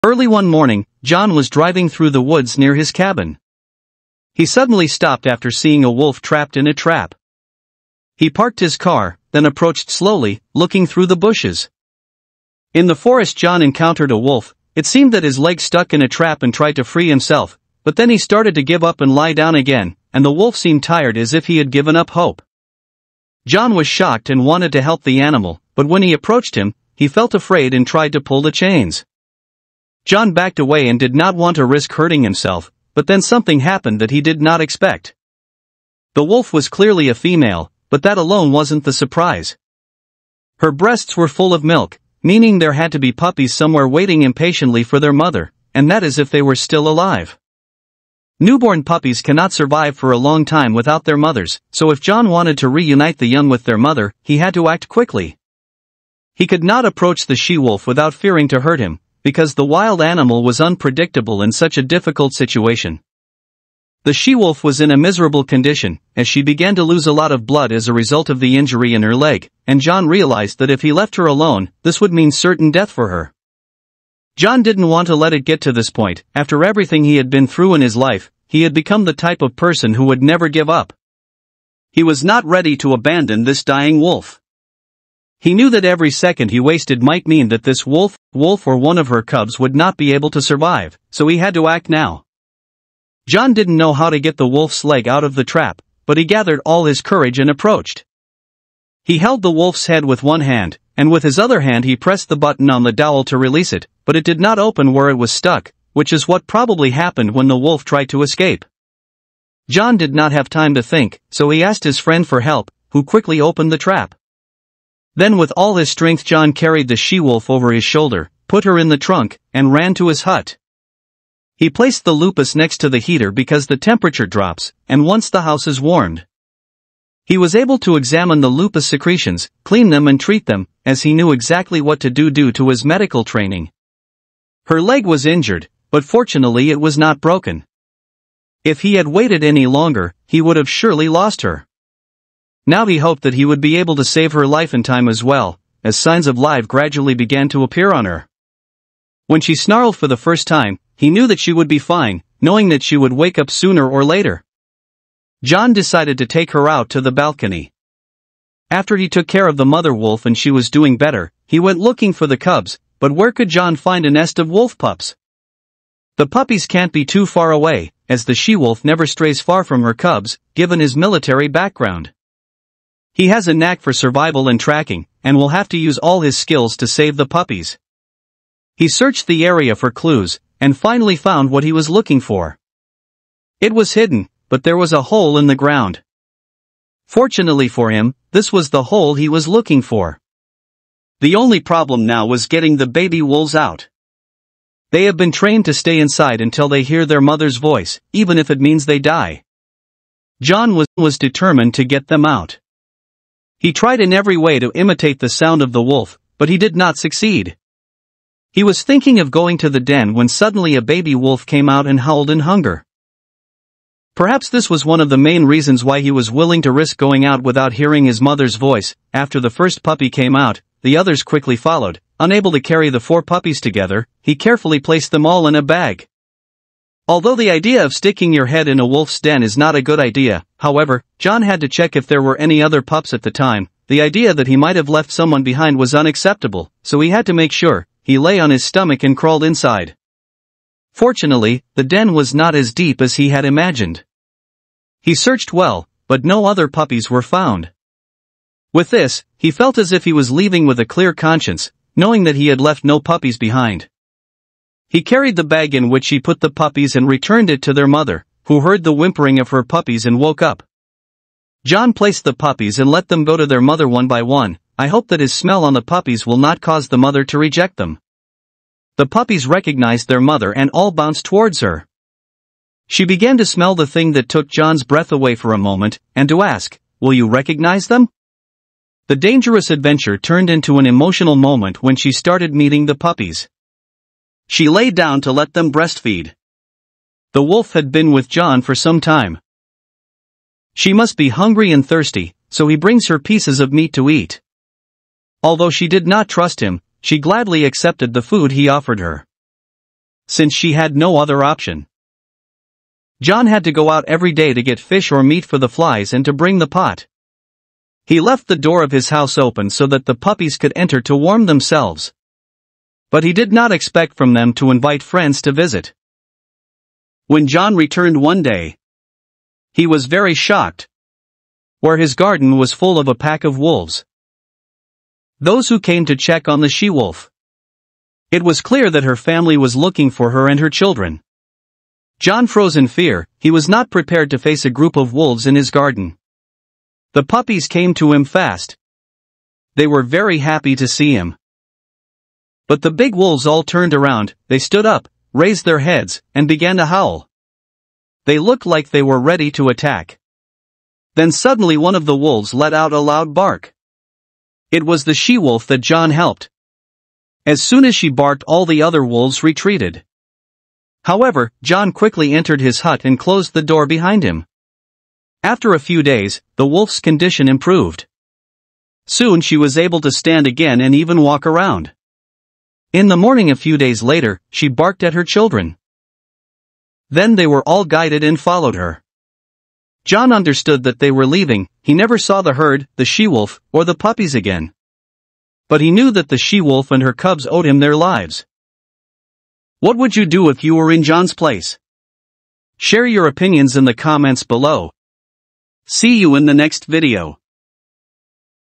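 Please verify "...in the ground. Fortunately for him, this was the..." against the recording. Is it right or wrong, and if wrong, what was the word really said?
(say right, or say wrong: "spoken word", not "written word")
right.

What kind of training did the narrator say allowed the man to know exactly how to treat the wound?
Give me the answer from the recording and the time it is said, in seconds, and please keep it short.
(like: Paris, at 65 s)
Medical training, at 132 s.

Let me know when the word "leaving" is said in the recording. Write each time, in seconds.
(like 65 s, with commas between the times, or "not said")
250 s, 381 s.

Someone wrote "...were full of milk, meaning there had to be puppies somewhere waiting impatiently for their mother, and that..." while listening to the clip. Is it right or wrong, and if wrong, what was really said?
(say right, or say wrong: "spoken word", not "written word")
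right.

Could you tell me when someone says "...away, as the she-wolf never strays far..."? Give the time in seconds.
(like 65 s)
167 s.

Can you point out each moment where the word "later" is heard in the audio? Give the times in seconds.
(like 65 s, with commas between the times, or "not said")
154 s, 374 s.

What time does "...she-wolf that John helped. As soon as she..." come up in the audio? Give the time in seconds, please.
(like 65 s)
355 s.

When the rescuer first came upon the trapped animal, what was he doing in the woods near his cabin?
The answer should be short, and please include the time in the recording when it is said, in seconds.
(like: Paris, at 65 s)
Driving, at 1 s.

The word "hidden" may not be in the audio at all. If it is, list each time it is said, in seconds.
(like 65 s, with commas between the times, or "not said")
183 s.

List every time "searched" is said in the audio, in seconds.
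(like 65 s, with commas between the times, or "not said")
178 s, 245 s.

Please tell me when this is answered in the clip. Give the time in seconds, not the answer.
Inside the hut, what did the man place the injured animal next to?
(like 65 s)
122 s.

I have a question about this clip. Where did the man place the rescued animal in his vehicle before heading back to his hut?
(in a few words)
The trunk.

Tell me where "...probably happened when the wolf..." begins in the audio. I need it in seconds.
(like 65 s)
106 s.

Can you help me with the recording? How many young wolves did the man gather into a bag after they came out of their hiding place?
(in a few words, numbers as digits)
4.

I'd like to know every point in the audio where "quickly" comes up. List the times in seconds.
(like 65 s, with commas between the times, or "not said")
54 s, 113 s, 221 s, 361 s.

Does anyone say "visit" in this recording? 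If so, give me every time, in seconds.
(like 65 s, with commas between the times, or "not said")
315 s.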